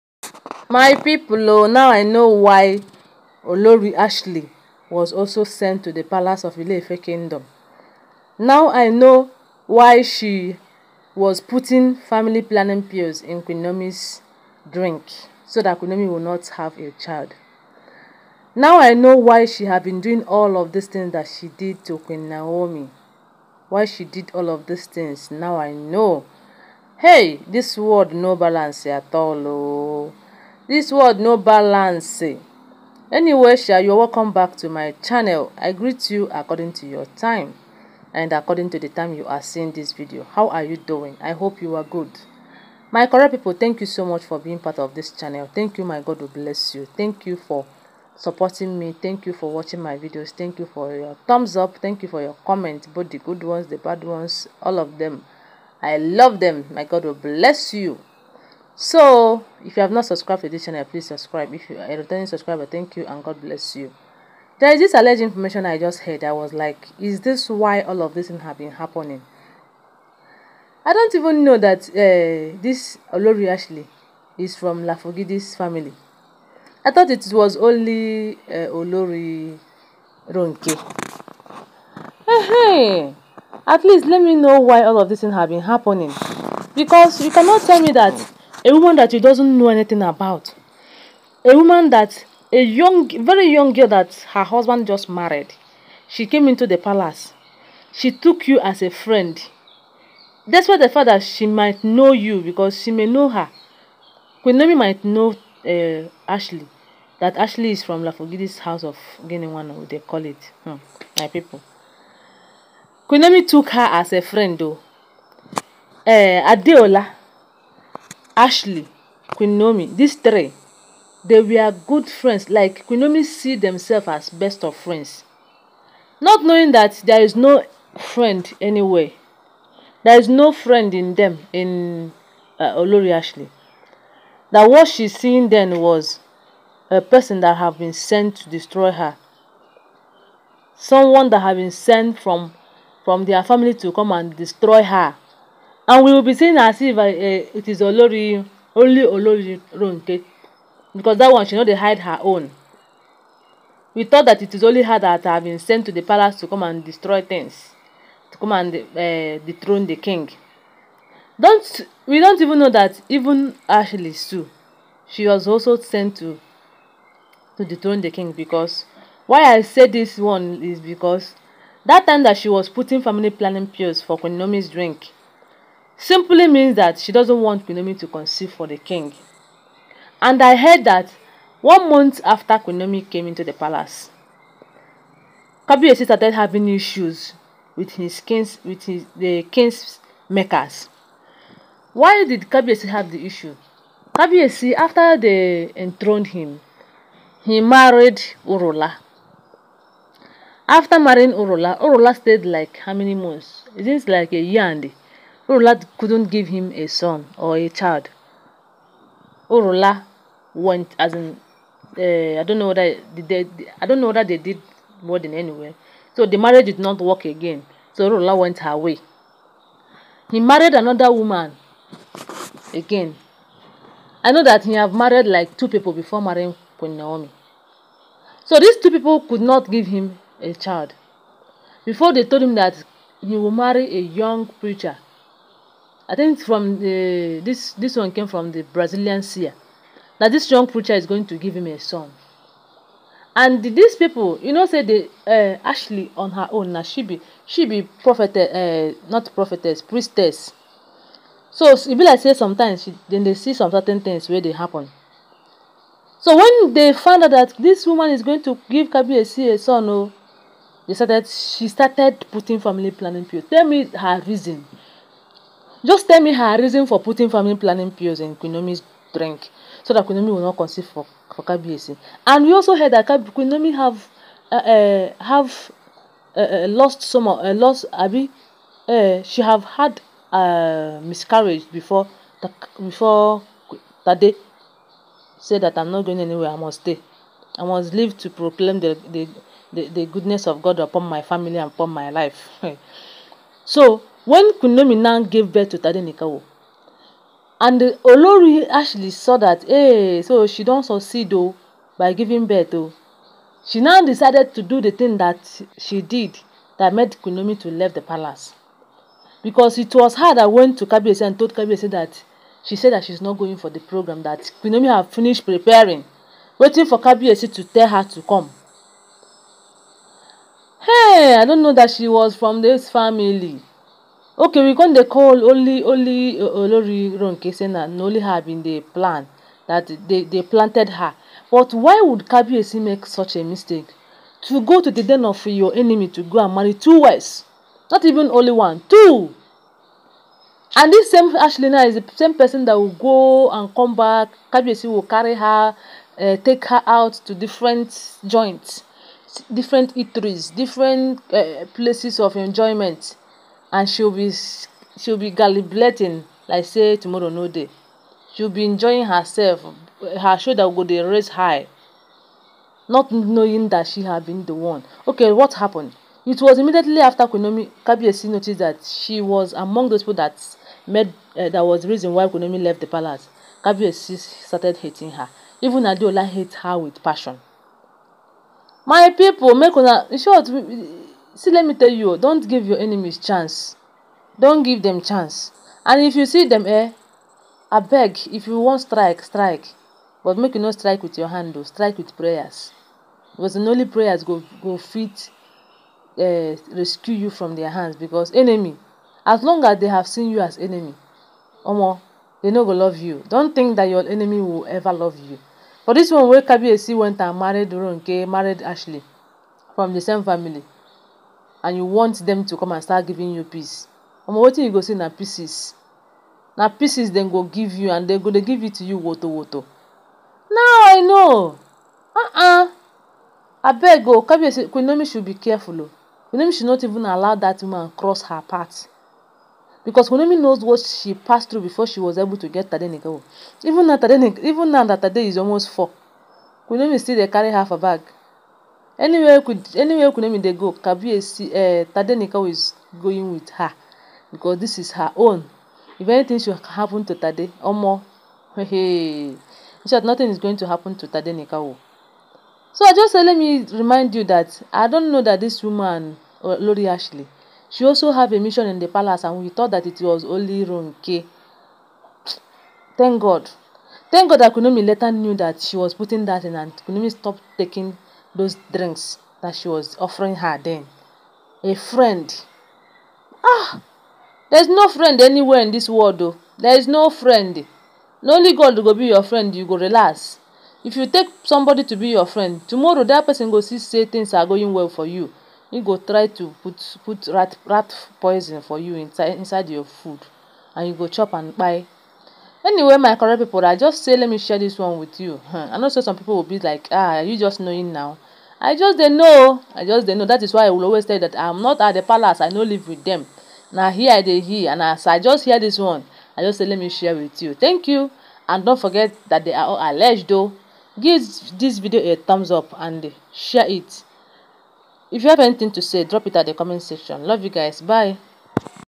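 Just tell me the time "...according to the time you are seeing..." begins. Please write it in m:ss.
0:38.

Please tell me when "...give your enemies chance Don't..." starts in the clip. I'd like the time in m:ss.
6:22.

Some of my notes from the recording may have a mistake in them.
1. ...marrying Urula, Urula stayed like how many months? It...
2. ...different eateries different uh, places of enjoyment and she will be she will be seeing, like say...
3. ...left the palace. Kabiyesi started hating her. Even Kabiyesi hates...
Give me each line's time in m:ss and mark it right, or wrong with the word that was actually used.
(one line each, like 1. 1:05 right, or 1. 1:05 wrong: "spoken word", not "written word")
1. 3:20 right
2. 5:49 wrong: "gallivanting", not "seeing"
3. 6:12 wrong: "Adeola", not "Kabiyesi".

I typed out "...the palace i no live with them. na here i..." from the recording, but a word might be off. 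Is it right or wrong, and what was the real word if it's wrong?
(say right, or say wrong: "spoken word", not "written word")
right.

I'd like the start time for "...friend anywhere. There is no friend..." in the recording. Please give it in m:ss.
2:07.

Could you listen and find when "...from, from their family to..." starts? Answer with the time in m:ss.
2:22.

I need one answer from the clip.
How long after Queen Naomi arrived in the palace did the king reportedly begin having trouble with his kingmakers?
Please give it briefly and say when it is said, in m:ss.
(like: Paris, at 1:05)
One month, at 3:01.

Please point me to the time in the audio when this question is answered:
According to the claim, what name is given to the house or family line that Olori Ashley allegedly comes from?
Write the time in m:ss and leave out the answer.
1:49.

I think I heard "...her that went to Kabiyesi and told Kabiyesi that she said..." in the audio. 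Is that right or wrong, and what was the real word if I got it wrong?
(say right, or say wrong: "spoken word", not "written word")
right.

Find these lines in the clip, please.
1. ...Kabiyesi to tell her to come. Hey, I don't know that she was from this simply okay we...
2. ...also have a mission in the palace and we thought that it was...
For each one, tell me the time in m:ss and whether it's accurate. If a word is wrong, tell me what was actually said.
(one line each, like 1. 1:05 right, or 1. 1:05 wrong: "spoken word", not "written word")
1. 5:17 wrong: "family", not "simply"
2. 7:37 right.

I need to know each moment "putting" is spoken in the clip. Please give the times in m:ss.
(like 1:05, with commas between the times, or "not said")
0:11, 2:52, 4:22, 4:26, 7:45.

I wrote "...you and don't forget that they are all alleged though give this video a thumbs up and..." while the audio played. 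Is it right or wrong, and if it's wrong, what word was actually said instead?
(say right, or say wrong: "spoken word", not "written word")
right.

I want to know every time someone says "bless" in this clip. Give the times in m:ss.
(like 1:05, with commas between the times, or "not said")
0:46, 0:57, 1:03.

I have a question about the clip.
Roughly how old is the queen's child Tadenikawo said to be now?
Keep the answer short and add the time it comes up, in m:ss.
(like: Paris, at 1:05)
Almost 4, at 7:15.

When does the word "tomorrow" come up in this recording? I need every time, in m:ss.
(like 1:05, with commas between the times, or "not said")
5:56, 8:02.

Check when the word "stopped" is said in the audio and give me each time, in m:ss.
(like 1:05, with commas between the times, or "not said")
7:47.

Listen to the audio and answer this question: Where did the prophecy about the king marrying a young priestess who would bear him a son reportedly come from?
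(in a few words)
Brazilian seer.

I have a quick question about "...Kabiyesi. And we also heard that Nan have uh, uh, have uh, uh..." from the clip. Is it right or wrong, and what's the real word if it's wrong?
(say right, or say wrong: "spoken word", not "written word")
wrong: "Kunomi", not "Nan".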